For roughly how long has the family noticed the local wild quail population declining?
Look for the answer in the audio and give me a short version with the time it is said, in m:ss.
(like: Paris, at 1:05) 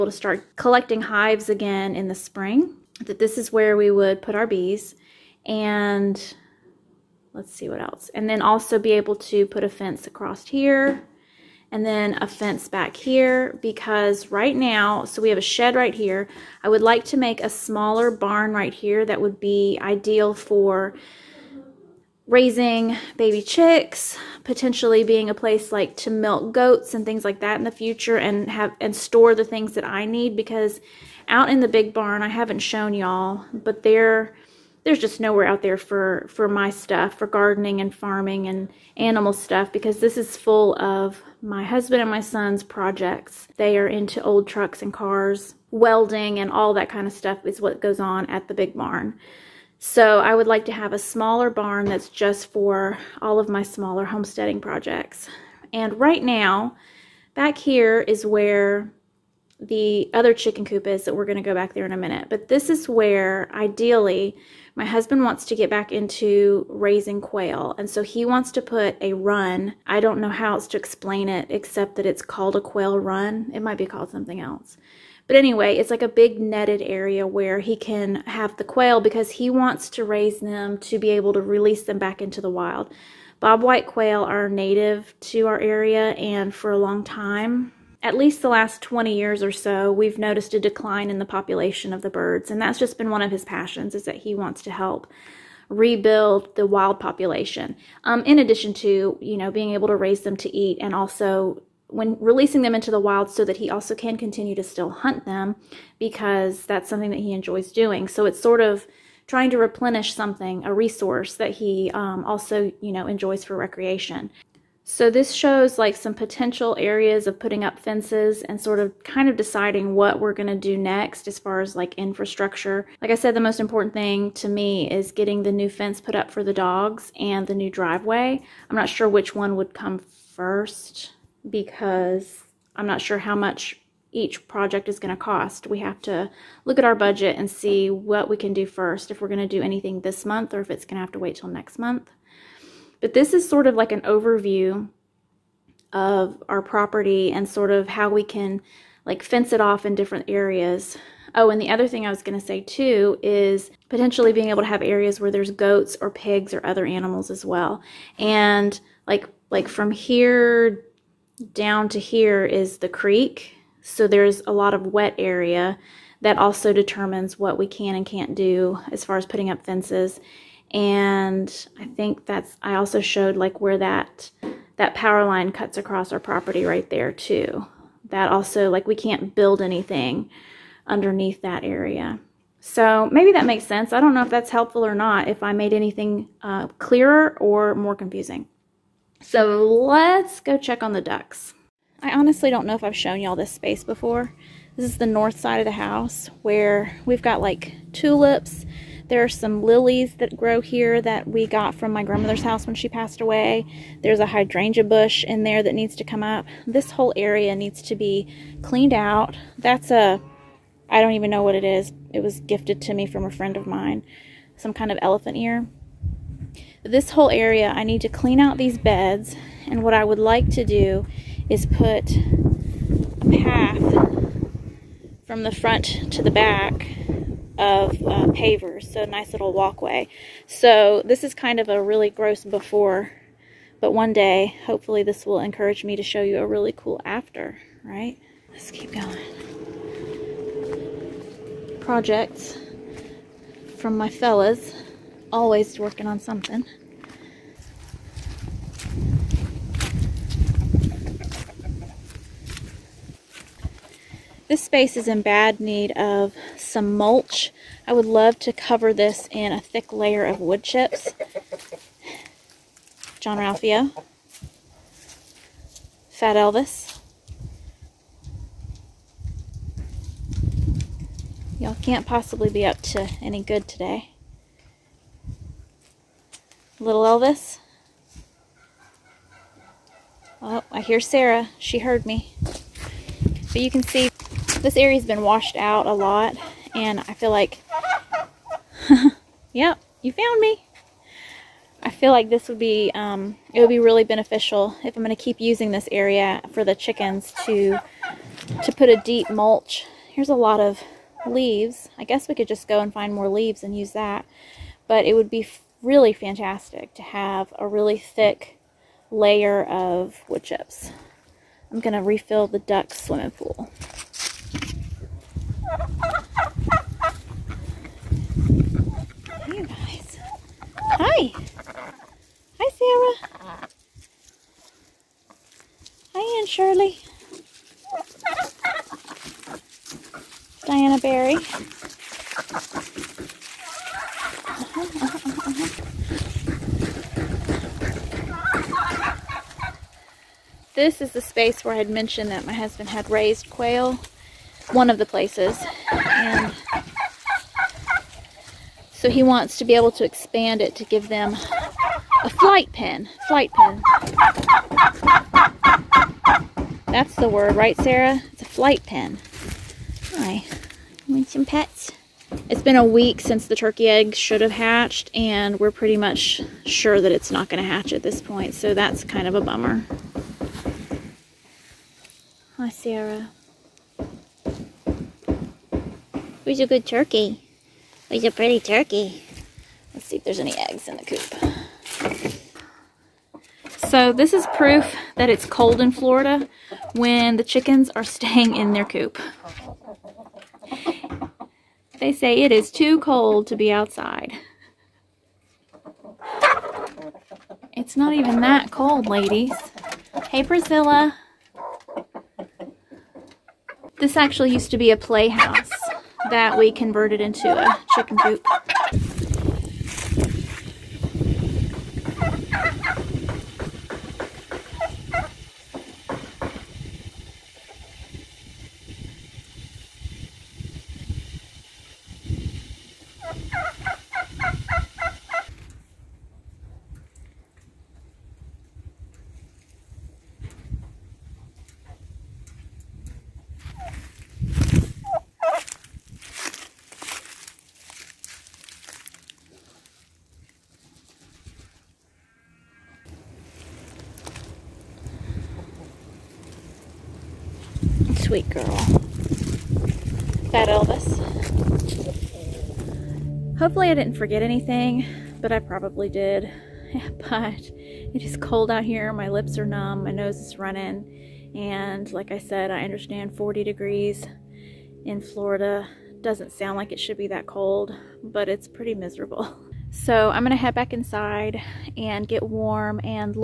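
20 years, at 1:28.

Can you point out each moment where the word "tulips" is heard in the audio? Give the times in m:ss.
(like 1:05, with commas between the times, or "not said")
3:17.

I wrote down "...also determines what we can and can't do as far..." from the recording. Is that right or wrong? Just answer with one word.
right.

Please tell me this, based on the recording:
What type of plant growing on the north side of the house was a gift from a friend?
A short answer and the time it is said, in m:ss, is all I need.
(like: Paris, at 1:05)
Elephant ear, at 3:35.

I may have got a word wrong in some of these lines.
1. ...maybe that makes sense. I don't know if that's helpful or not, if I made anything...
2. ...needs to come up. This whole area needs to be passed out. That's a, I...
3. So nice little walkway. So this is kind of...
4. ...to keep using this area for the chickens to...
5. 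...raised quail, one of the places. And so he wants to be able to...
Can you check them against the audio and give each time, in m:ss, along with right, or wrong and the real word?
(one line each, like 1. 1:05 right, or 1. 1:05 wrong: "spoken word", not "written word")
1. 3:03 right
2. 3:25 wrong: "cleaned", not "passed"
3. 3:48 right
4. 4:55 right
5. 5:43 right.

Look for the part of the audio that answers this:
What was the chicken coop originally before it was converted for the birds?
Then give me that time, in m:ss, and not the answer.
6:44.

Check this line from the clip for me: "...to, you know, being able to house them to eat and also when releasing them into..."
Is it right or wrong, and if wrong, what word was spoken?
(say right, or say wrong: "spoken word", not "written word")
wrong: "raise", not "house".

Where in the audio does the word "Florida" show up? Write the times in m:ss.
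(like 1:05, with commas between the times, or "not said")
6:25, 7:45.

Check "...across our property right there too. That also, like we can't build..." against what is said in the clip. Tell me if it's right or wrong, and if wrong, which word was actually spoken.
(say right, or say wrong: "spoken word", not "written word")
right.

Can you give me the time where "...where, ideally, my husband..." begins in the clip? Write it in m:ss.
1:02.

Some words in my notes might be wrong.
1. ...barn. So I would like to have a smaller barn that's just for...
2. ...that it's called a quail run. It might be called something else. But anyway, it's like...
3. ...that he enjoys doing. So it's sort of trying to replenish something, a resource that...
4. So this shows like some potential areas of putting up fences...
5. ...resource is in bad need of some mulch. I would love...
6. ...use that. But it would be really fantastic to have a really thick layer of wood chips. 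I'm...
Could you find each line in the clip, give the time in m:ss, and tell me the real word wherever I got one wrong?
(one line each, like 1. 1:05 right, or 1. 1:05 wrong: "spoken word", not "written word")
1. 0:48 right
2. 1:11 right
3. 1:47 right
4. 1:54 right
5. 4:14 wrong: "space", not "resource"
6. 5:03 right.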